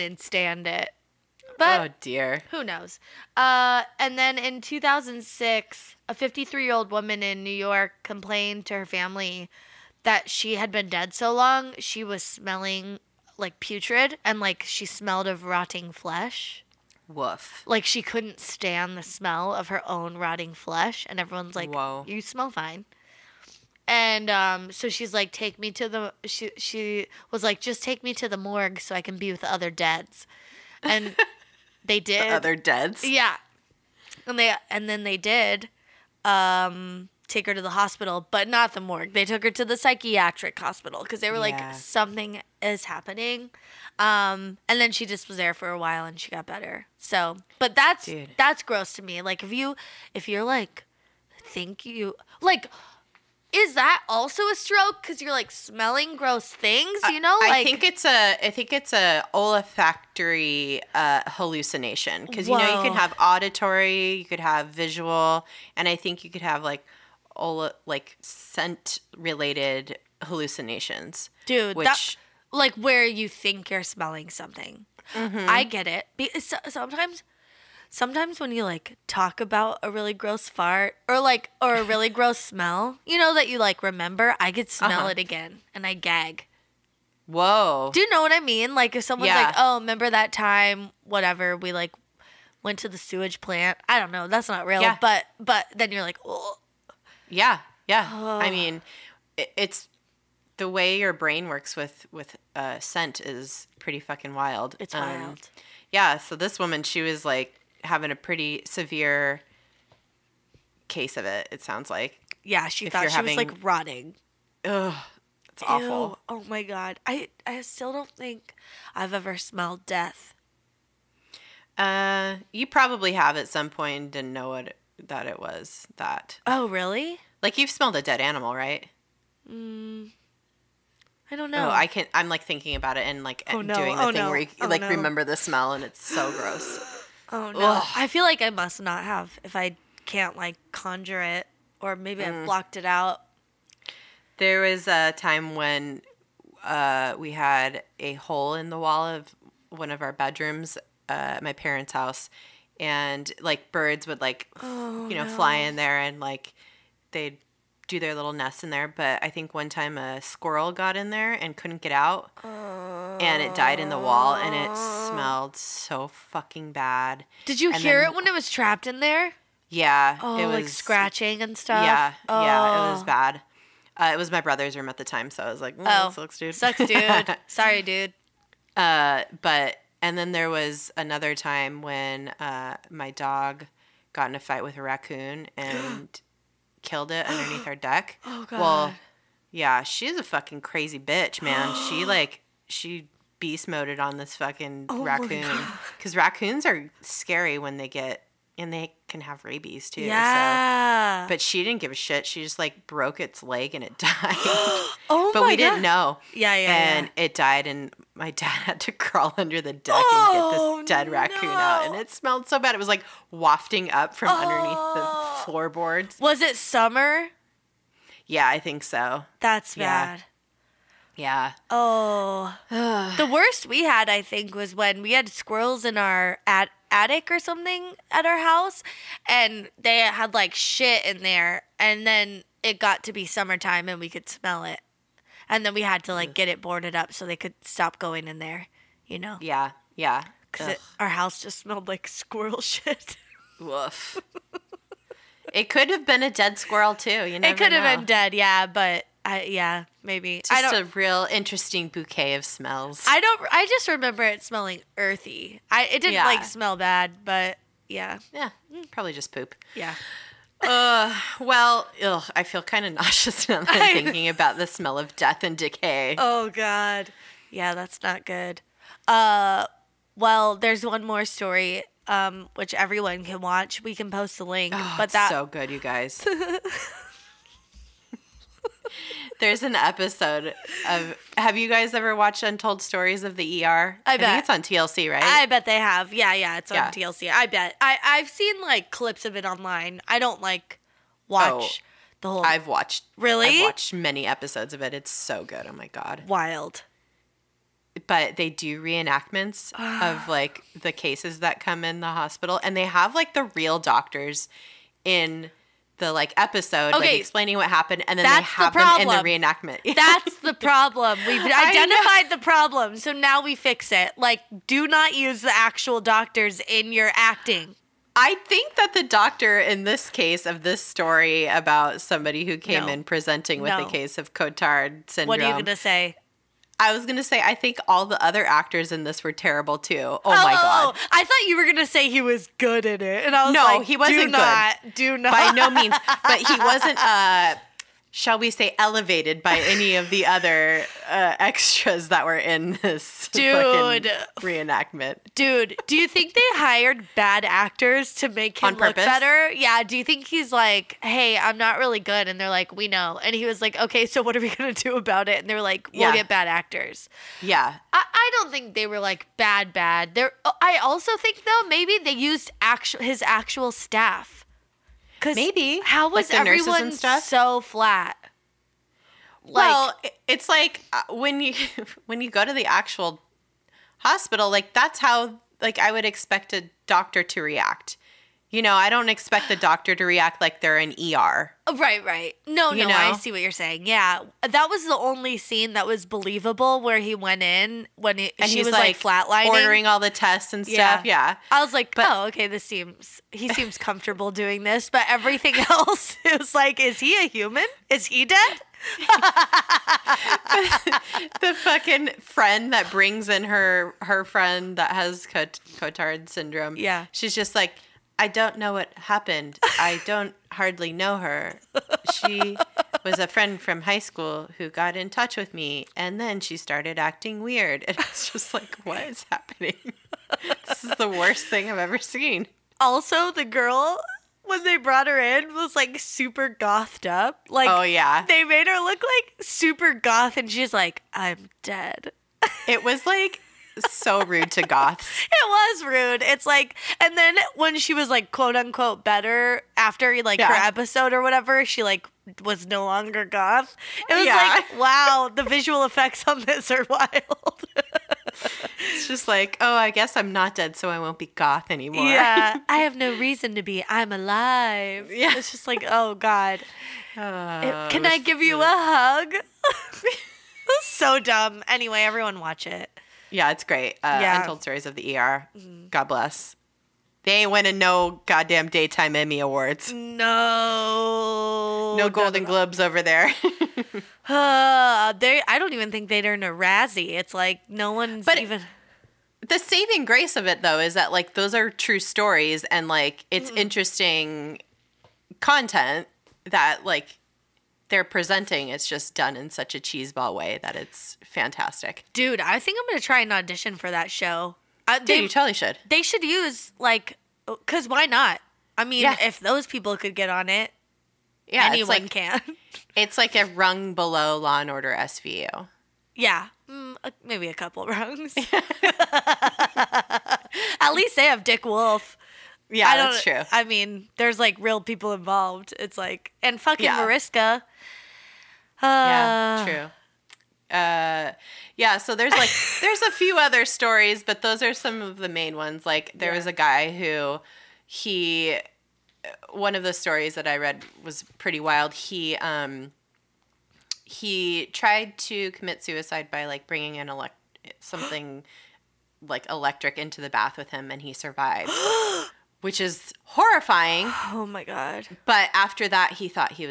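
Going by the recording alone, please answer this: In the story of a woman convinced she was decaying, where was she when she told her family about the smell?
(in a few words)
New York.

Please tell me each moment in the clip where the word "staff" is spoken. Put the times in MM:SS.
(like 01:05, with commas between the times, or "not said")
06:03.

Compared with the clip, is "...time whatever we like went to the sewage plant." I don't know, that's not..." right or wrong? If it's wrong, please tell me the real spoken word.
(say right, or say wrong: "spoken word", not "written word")
right.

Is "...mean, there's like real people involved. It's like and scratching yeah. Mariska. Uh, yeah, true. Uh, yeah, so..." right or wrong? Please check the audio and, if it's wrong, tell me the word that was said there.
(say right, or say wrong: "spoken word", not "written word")
wrong: "fucking", not "scratching".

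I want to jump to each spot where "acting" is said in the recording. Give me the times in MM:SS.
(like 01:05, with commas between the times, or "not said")
05:17, 06:56.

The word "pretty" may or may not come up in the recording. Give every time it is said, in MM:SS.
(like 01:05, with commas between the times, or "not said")
01:43, 01:48, 08:51.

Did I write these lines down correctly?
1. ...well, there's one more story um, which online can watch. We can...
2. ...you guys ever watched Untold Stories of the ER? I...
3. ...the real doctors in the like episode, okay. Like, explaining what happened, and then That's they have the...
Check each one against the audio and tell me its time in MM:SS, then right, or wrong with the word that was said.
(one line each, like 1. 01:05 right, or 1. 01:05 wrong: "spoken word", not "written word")
1. 04:30 wrong: "everyone", not "online"
2. 04:41 right
3. 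05:03 right.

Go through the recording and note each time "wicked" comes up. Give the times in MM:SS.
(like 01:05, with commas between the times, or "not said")
not said.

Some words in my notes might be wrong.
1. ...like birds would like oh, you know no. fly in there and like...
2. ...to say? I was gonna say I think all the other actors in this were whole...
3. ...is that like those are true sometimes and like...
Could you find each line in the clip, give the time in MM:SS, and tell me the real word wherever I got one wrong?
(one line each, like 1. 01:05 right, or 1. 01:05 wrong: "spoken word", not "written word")
1. 02:33 right
2. 05:25 wrong: "terrible", not "whole"
3. 08:00 wrong: "stories", not "sometimes".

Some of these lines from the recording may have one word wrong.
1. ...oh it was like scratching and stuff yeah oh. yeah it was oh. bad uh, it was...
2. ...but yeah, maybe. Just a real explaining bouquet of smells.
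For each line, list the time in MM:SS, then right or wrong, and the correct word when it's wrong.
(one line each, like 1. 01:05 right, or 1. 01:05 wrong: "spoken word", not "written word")
1. 02:50 right
2. 04:08 wrong: "interesting", not "explaining".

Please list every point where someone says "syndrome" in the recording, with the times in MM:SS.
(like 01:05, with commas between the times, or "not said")
05:25, 06:46.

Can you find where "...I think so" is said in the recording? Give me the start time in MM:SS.
03:38.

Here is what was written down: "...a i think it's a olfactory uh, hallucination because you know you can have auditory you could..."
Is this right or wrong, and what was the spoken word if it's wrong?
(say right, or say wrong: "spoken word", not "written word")
right.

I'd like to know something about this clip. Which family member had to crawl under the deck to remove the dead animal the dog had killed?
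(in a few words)
dad.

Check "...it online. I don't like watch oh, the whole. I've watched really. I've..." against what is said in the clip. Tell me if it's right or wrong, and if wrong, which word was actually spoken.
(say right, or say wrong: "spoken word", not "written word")
right.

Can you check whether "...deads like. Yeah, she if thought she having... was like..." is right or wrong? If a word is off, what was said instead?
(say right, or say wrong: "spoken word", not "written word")
wrong: "sounds", not "deads".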